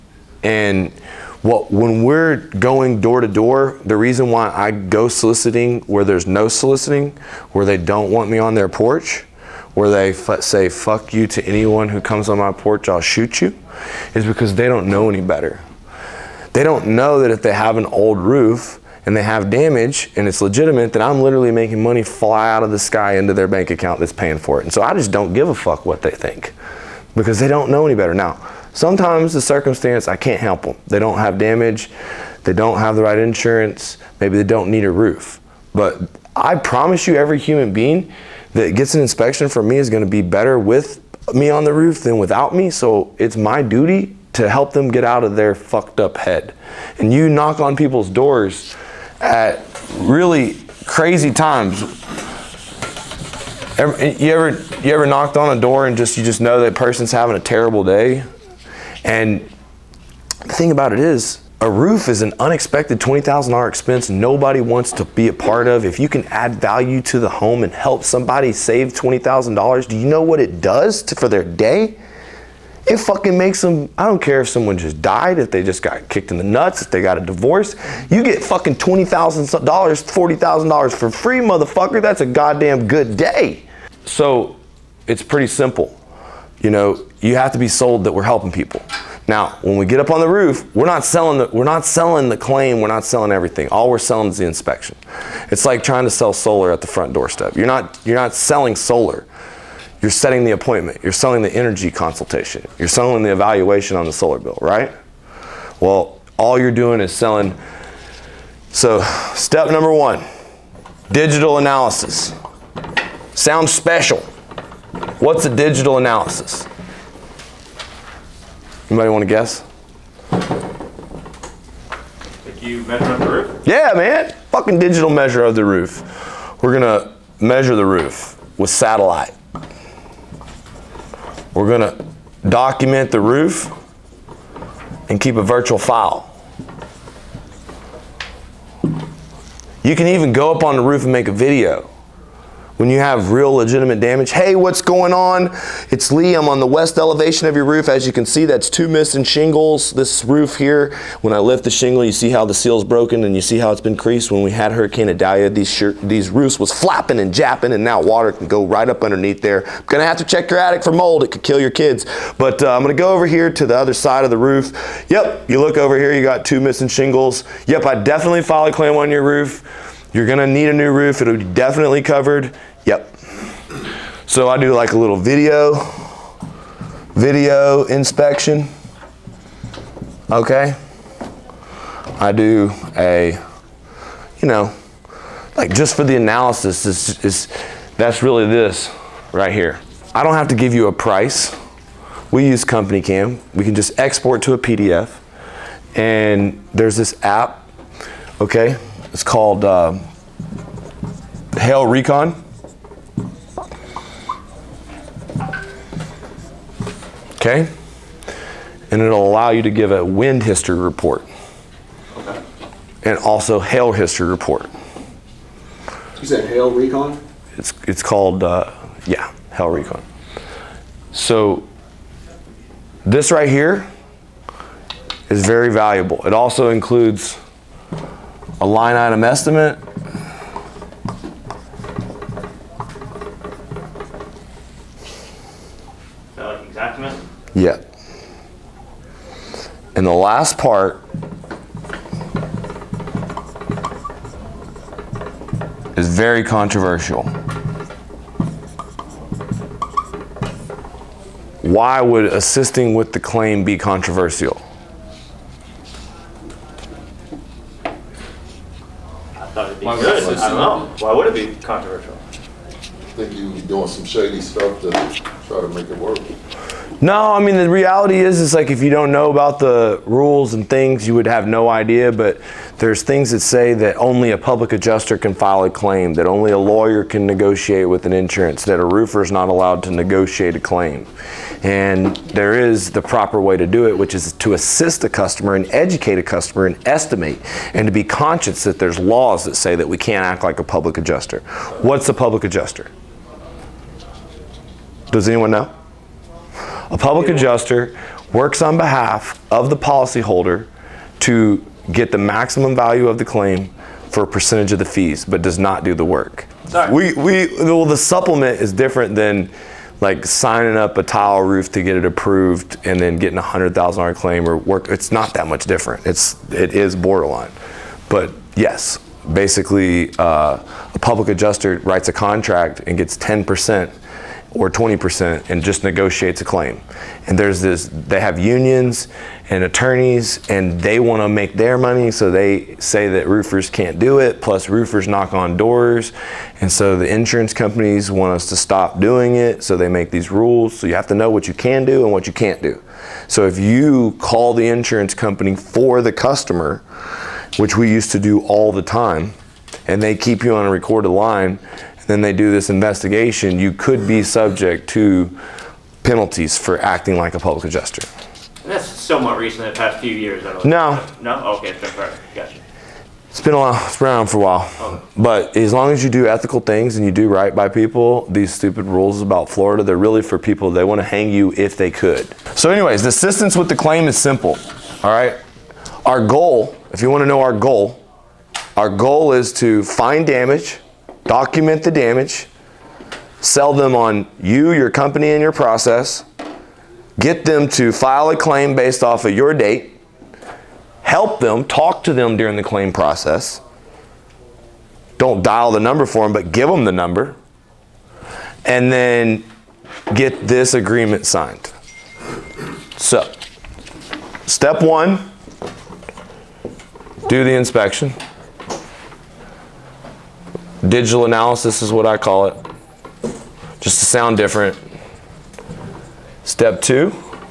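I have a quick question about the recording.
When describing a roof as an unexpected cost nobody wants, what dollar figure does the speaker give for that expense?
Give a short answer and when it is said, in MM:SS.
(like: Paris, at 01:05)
$20,000, at 01:02.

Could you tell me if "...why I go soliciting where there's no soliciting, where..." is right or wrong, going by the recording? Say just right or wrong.
right.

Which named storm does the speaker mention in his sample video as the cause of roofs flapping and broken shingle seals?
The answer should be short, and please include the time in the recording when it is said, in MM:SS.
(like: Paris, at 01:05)
Hurricane Idalia, at 02:34.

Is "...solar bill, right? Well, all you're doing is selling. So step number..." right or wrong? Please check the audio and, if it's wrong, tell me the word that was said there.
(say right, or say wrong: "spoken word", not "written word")
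right.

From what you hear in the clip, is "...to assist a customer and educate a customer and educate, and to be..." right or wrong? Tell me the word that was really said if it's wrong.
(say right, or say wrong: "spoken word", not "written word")
wrong: "estimate", not "educate".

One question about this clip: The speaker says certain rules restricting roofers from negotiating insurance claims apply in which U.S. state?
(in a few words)
Florida.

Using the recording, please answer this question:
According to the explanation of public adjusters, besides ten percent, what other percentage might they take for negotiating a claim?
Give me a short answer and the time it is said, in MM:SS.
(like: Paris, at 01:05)
20%, at 05:24.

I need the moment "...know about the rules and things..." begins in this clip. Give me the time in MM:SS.
04:29.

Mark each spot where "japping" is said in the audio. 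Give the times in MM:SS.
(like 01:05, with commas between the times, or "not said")
02:37.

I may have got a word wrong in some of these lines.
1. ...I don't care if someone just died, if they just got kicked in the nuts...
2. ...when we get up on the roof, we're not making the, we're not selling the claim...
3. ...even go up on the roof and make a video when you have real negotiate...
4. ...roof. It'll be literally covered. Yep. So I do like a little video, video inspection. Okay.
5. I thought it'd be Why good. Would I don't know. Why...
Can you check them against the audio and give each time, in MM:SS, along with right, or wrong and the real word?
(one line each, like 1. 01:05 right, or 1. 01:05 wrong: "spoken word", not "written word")
1. 01:13 right
2. 01:29 wrong: "selling", not "making"
3. 02:20 wrong: "legitimate", not "negotiate"
4. 02:50 wrong: "definitely", not "literally"
5. 04:17 right.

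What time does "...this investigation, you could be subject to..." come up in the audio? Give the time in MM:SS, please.
05:52.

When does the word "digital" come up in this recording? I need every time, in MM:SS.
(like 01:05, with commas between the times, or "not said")
01:51, 01:55, 02:04, 06:50.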